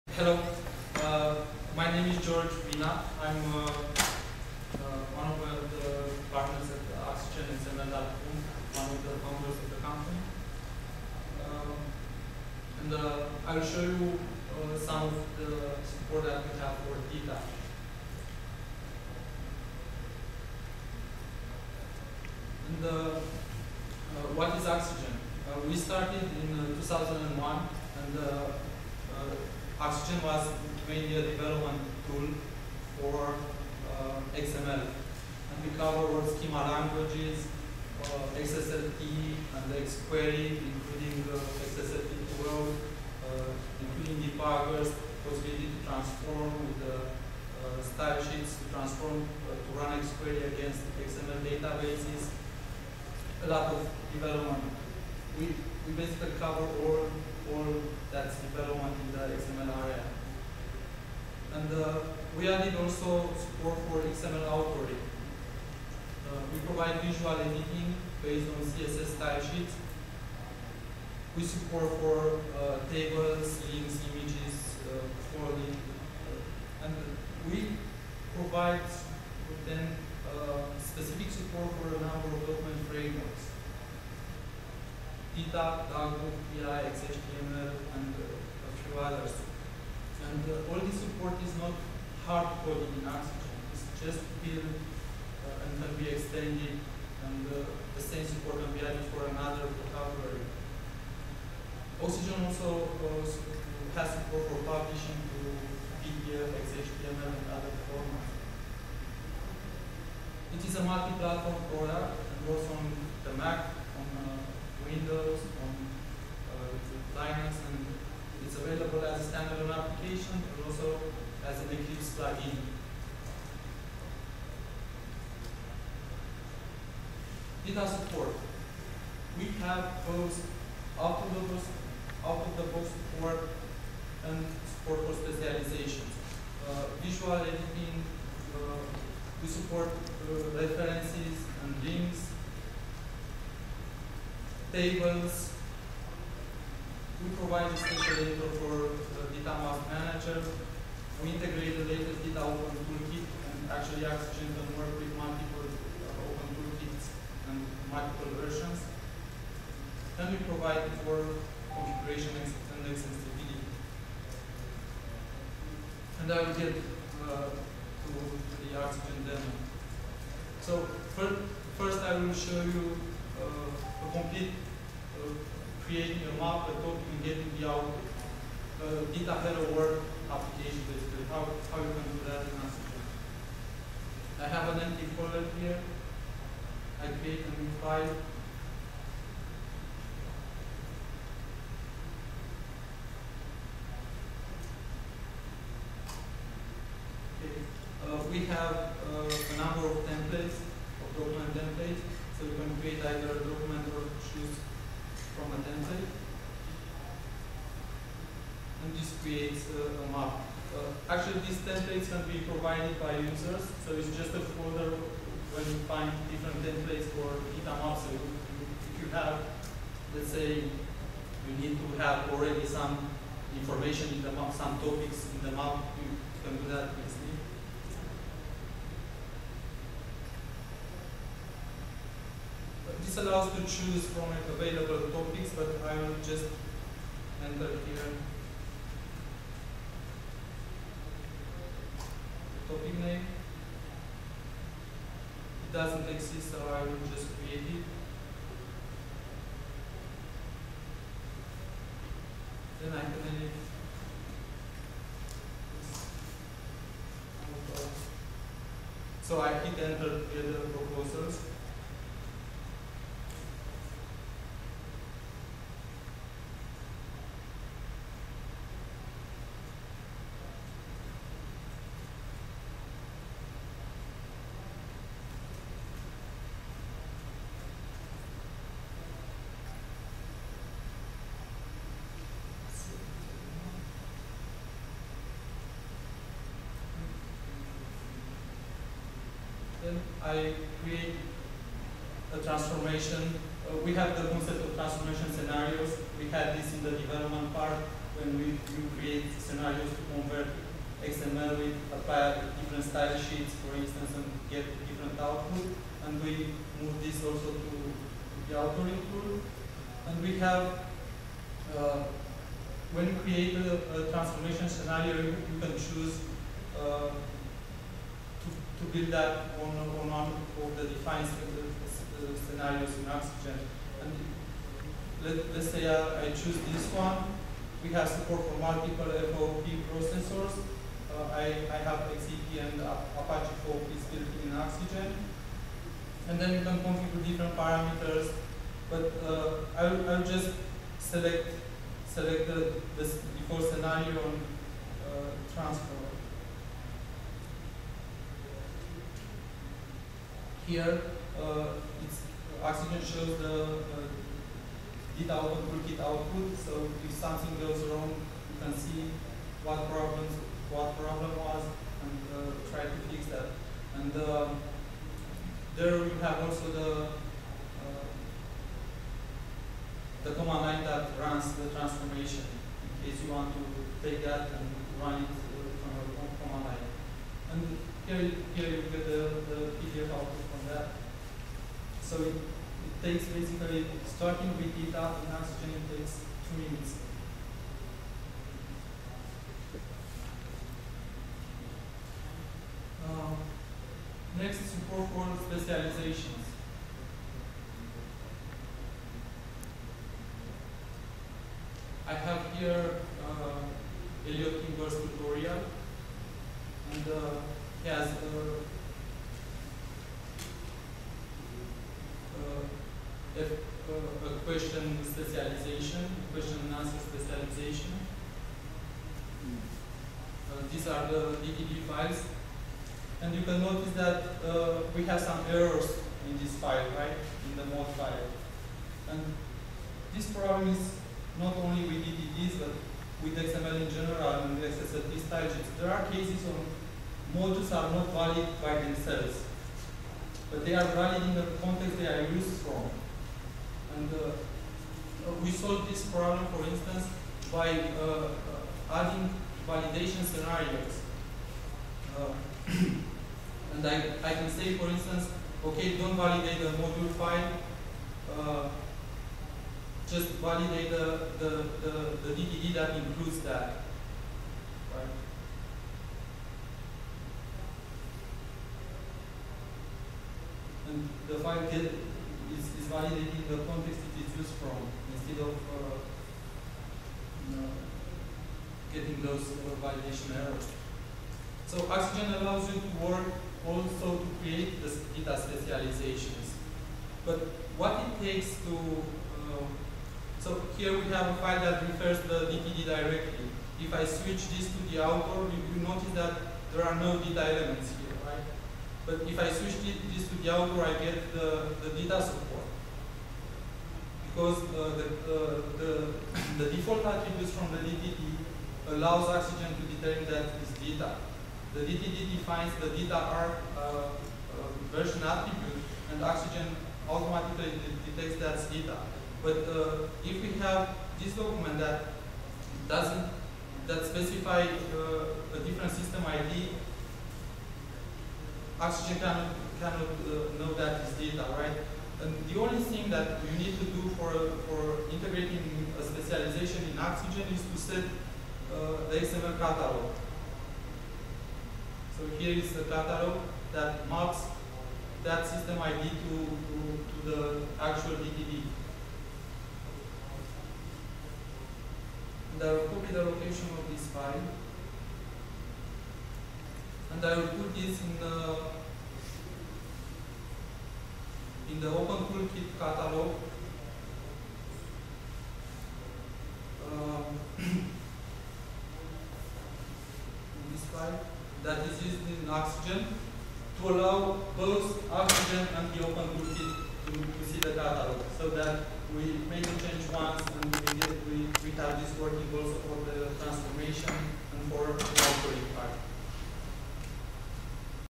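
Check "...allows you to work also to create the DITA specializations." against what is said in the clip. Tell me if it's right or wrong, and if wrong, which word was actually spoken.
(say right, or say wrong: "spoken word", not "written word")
right.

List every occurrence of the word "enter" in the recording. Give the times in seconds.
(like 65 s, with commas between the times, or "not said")
237 s, 259 s.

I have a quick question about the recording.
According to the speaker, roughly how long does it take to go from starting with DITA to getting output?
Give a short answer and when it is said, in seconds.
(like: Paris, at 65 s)
2 minutes, at 386 s.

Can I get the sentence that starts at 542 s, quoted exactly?
So here is the catalog that maps that system ID to, to, to the actual DTD.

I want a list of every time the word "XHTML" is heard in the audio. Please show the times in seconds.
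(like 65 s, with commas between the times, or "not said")
106 s.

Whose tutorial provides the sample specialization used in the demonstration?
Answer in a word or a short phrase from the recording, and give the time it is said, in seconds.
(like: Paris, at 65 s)
Elliot, at 404 s.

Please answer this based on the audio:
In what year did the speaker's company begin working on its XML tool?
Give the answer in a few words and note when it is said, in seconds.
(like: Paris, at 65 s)
2001, at 26 s.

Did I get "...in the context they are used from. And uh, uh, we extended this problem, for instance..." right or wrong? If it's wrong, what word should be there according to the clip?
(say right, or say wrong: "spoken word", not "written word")
wrong: "solved", not "extended".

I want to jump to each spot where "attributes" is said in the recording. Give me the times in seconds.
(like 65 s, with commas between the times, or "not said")
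507 s, 515 s.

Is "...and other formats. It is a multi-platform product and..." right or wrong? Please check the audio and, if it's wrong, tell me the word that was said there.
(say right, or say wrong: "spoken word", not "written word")
right.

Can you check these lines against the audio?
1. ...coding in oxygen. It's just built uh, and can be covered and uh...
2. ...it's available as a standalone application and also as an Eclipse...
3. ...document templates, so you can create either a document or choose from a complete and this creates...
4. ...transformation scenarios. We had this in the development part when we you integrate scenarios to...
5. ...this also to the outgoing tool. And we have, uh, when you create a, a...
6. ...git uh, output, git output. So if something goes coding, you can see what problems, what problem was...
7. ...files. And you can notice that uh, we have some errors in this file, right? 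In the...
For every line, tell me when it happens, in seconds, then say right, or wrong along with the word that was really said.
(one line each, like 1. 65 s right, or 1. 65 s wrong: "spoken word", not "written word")
1. 92 s wrong: "extended", not "covered"
2. 118 s right
3. 201 s wrong: "template", not "complete"
4. 294 s wrong: "create", not "integrate"
5. 307 s wrong: "authoring", not "outgoing"
6. 355 s wrong: "wrong", not "coding"
7. 421 s right.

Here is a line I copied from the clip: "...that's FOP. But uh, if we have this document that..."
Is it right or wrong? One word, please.
wrong.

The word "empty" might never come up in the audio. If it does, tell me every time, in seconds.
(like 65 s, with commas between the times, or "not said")
184 s.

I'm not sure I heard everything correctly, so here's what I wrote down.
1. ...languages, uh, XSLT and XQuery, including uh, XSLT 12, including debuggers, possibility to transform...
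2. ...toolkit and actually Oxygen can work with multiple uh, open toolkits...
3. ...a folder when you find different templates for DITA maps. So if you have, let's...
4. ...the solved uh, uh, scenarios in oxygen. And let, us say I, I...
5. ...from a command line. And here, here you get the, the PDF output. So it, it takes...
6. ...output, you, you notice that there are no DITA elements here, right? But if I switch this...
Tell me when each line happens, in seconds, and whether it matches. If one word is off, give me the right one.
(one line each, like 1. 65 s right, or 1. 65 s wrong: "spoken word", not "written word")
1. 36 s right
2. 152 s right
3. 214 s right
4. 320 s wrong: "defined", not "solved"
5. 375 s right
6. 495 s right.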